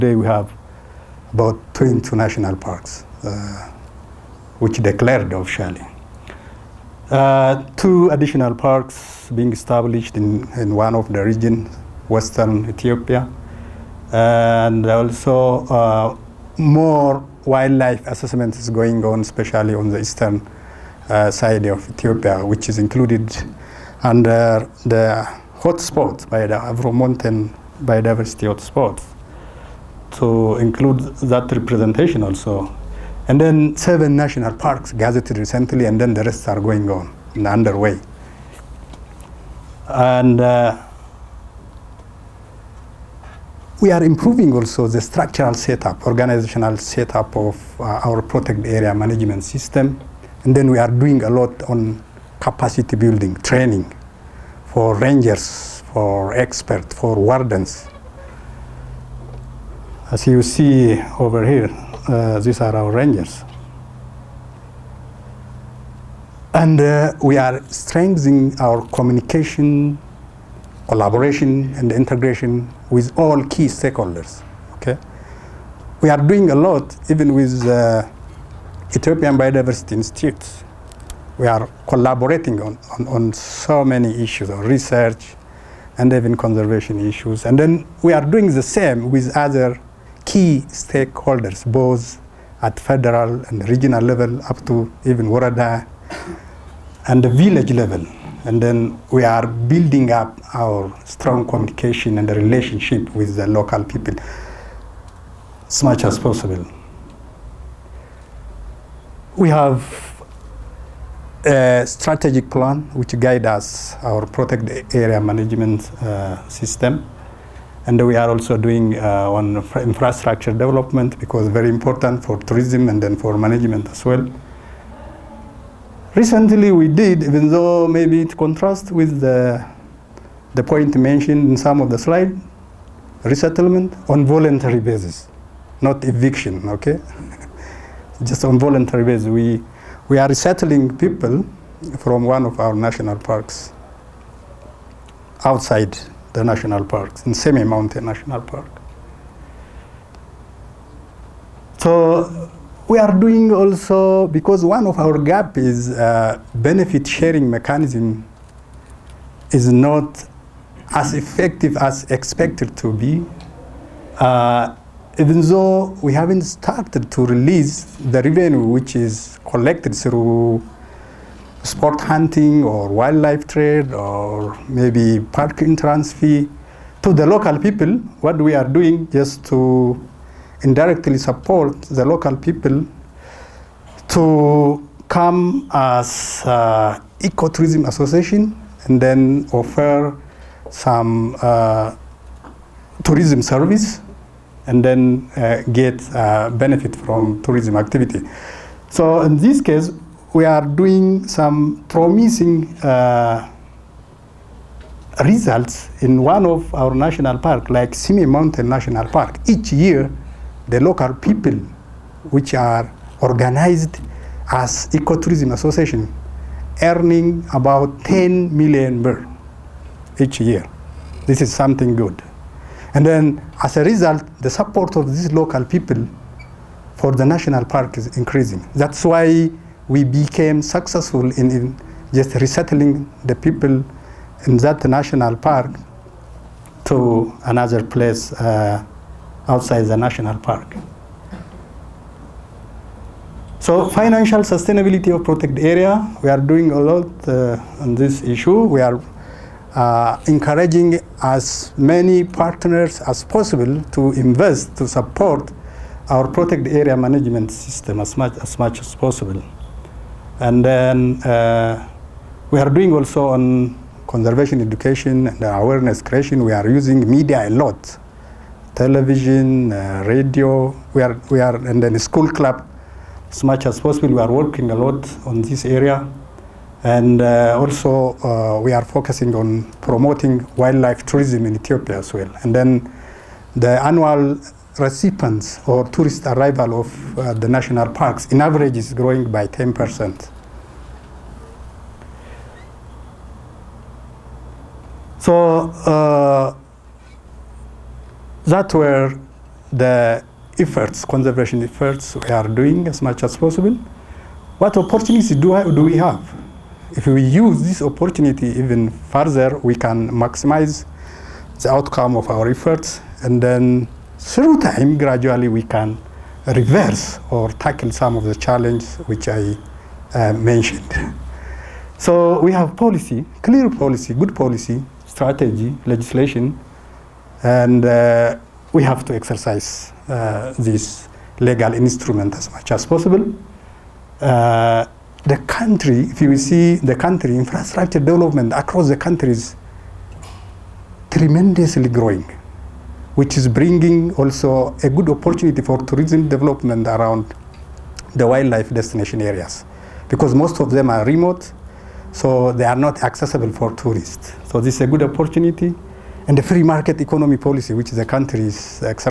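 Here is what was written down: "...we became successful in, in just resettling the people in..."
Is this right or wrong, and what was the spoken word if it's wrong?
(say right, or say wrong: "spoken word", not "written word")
right.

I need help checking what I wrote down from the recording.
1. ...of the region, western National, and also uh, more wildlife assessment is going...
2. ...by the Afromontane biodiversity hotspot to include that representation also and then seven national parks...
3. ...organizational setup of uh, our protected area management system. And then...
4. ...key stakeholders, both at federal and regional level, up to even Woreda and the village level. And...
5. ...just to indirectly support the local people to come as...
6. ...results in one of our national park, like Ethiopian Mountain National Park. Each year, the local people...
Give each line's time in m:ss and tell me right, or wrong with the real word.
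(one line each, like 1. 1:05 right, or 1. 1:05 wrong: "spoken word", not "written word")
1. 0:10 wrong: "Ethiopia", not "National"
2. 0:26 right
3. 0:46 right
4. 1:30 right
5. 2:59 right
6. 3:25 wrong: "Simien", not "Ethiopian".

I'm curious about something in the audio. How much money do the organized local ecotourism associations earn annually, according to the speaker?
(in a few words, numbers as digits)
10 million birr.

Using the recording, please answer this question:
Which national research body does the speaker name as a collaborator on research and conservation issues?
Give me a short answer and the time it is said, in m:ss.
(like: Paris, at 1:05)
Ethiopian Biodiversity Institute, at 1:18.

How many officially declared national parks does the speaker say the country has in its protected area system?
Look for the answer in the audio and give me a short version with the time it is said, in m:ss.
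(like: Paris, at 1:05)
22, at 0:01.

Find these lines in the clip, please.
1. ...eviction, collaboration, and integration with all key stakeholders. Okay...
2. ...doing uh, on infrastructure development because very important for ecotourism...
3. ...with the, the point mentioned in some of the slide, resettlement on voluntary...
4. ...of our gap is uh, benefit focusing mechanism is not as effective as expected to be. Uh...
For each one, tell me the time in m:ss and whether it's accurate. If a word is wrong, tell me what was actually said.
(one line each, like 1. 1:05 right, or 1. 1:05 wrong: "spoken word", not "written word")
1. 1:08 wrong: "communication", not "eviction"
2. 1:58 wrong: "tourism", not "ecotourism"
3. 2:08 right
4. 2:34 wrong: "sharing", not "focusing".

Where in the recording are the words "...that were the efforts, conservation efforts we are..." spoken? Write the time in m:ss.
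4:58.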